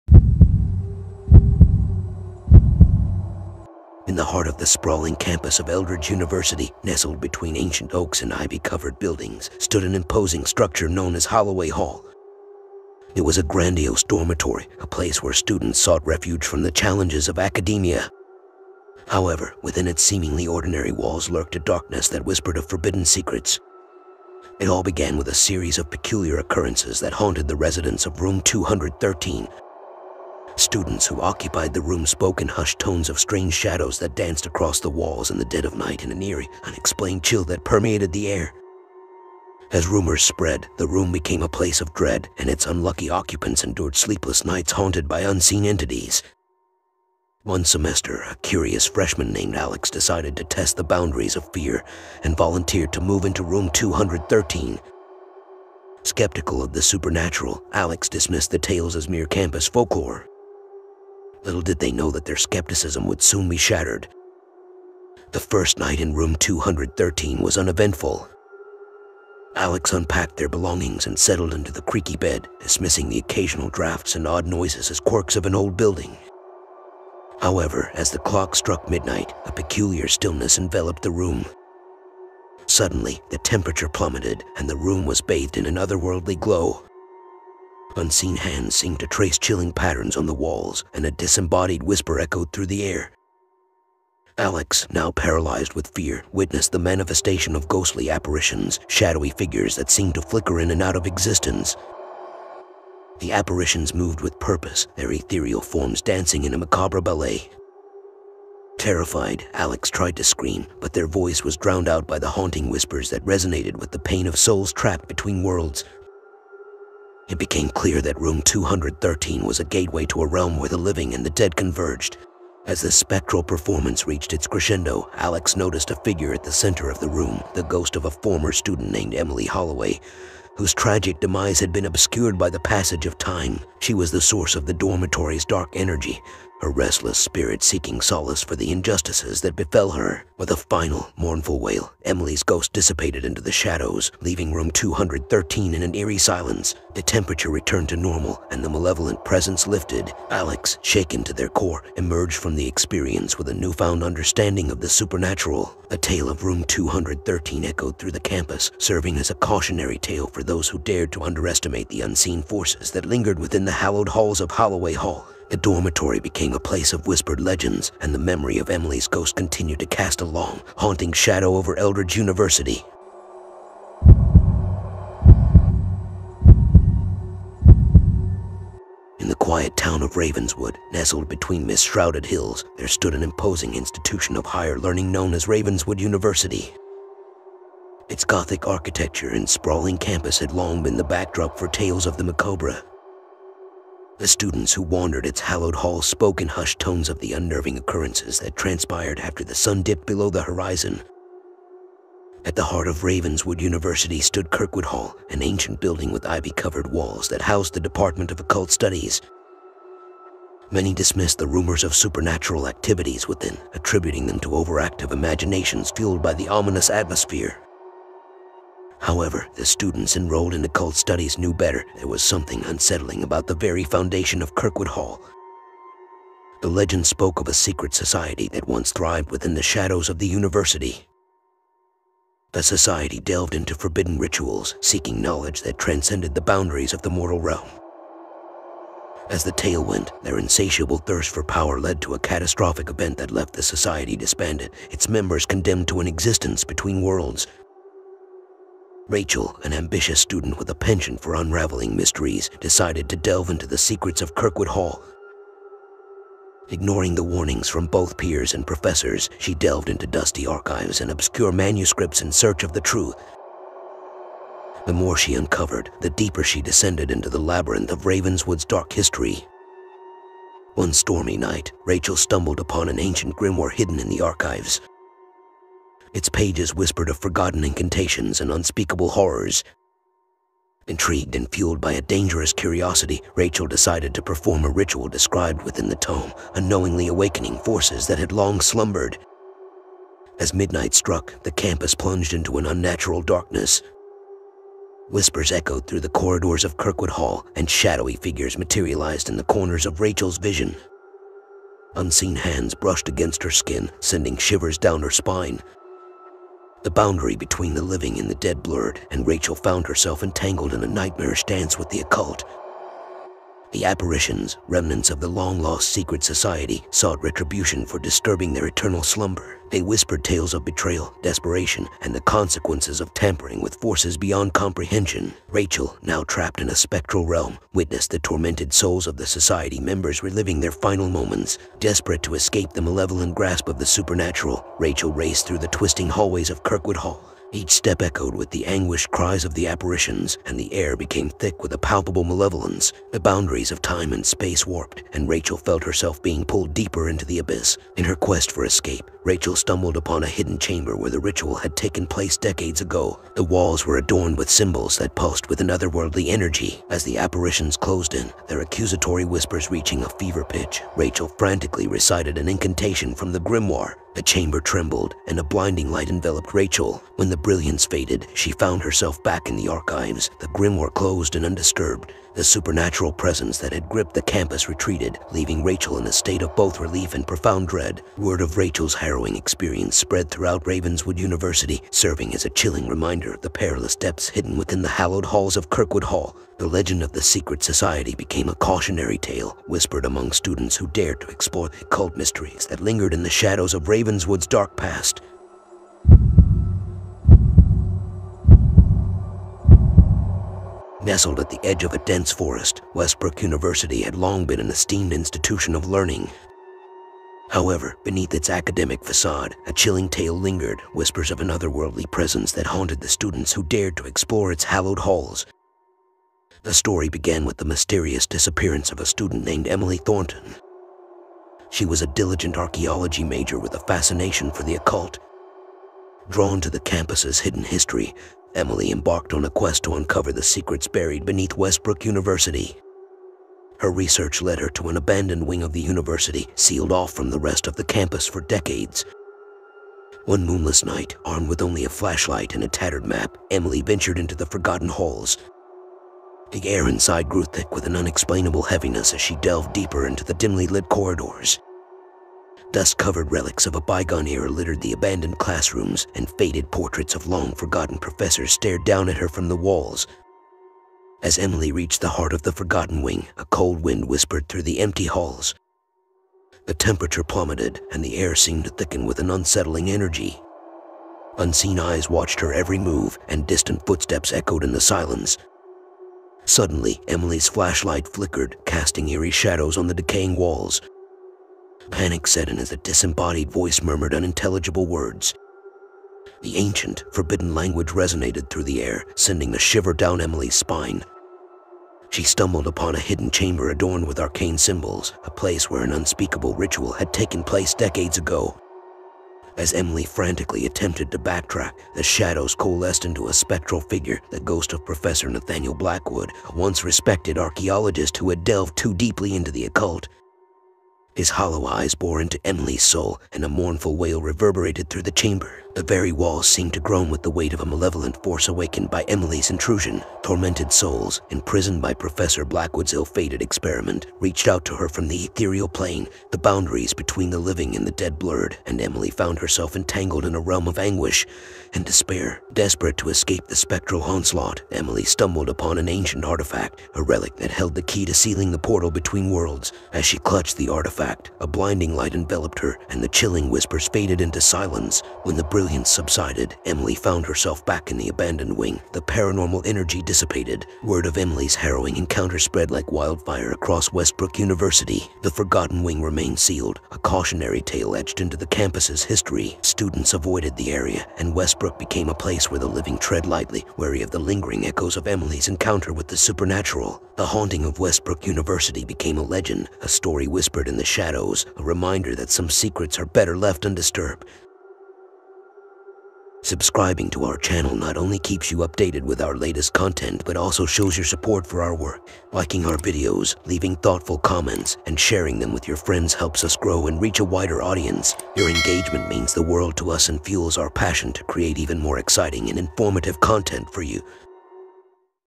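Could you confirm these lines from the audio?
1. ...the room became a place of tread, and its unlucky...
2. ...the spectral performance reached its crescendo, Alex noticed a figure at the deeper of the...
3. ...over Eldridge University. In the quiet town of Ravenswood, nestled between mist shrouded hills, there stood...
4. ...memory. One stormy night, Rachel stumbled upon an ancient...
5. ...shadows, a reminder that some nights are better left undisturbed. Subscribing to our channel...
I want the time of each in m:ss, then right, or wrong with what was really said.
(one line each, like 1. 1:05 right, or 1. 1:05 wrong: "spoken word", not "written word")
1. 0:40 wrong: "dread", not "tread"
2. 2:02 wrong: "center", not "deeper"
3. 2:51 right
4. 4:28 wrong: "history", not "memory"
5. 9:30 wrong: "secrets", not "nights".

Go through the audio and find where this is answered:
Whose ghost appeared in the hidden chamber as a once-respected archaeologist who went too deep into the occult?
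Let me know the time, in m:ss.
8:24.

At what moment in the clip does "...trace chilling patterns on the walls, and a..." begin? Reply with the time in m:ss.
1:29.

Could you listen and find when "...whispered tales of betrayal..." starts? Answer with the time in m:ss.
5:19.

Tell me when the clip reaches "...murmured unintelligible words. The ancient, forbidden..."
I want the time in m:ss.
8:03.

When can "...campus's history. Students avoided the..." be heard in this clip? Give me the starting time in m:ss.
9:18.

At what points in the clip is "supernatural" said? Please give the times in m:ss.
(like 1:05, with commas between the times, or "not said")
0:56, 2:34, 3:31, 5:33, 6:12, 9:26.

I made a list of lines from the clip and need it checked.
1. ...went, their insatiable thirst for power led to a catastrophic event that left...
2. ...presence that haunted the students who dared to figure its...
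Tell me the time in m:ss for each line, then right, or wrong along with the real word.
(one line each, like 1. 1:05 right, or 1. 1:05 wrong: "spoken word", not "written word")
1. 3:59 right
2. 6:52 wrong: "explore", not "figure".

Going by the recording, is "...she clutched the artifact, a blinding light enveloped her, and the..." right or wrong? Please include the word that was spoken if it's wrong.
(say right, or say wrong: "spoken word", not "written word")
right.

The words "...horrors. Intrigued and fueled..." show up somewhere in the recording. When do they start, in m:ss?
4:39.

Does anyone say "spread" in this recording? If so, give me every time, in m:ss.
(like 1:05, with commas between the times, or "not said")
0:40, 6:19, 9:12.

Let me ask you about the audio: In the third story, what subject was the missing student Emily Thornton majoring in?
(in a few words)
Archaeology.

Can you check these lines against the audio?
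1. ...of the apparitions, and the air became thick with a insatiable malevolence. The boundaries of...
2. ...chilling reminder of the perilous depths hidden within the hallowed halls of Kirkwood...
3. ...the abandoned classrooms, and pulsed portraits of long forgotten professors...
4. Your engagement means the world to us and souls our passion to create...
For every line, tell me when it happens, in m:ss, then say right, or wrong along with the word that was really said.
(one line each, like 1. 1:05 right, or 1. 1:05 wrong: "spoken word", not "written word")
1. 5:39 wrong: "palpable", not "insatiable"
2. 6:22 right
3. 7:34 wrong: "faded", not "pulsed"
4. 9:48 wrong: "fuels", not "souls".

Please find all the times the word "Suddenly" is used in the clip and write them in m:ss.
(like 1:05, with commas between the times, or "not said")
1:22, 7:56.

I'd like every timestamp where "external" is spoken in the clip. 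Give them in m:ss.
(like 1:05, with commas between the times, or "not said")
not said.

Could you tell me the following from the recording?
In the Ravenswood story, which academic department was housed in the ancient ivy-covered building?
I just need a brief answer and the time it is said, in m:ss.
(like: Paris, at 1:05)
Department of Occult Studies, at 3:27.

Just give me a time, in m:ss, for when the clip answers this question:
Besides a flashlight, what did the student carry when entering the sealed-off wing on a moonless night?
7:22.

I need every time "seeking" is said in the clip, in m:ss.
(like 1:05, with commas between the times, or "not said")
2:17, 3:54.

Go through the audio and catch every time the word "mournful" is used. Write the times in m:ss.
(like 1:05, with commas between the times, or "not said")
2:21, 8:33.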